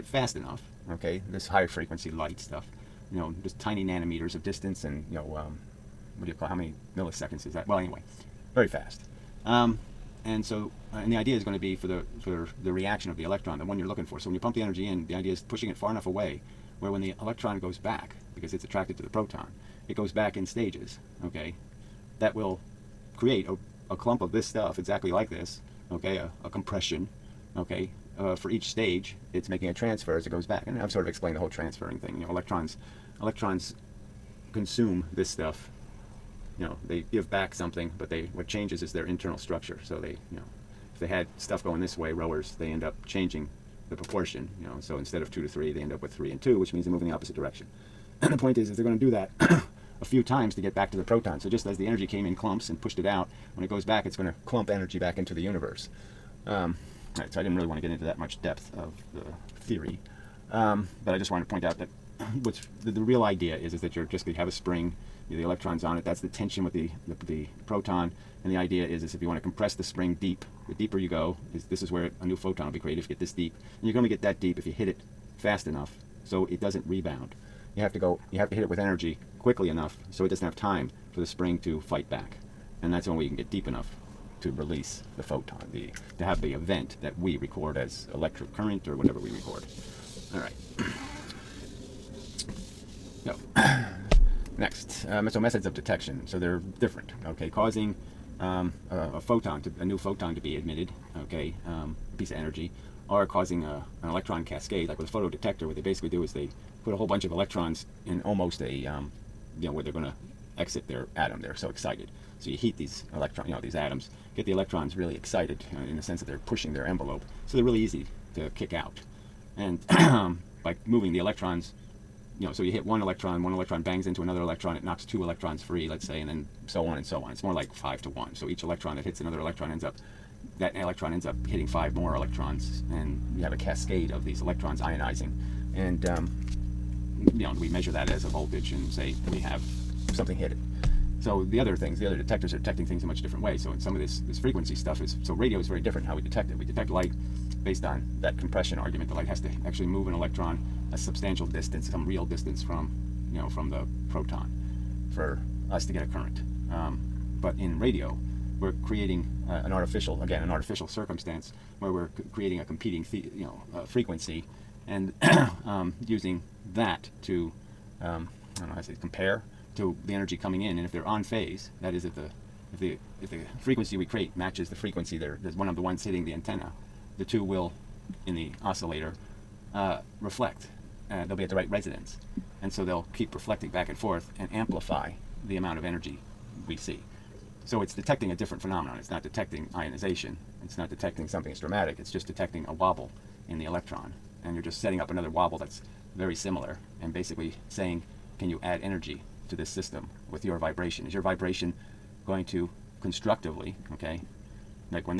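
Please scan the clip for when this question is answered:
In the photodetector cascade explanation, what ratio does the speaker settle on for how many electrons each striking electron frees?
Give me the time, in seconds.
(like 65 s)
127 s.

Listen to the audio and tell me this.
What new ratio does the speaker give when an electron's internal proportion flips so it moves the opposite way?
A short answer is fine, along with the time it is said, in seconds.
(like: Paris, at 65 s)
3 and 2, at 46 s.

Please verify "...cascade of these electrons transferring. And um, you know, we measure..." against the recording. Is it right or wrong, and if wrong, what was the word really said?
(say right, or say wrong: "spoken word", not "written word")
wrong: "ionizing", not "transferring".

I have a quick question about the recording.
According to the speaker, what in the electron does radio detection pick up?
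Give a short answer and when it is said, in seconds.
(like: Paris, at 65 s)
a wobble, at 192 s.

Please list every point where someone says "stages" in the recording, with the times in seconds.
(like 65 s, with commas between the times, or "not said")
20 s, 28 s.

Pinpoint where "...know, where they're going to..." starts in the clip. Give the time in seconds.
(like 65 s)
109 s.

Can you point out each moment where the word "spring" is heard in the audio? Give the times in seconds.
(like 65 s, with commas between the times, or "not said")
64 s, 69 s, 81 s.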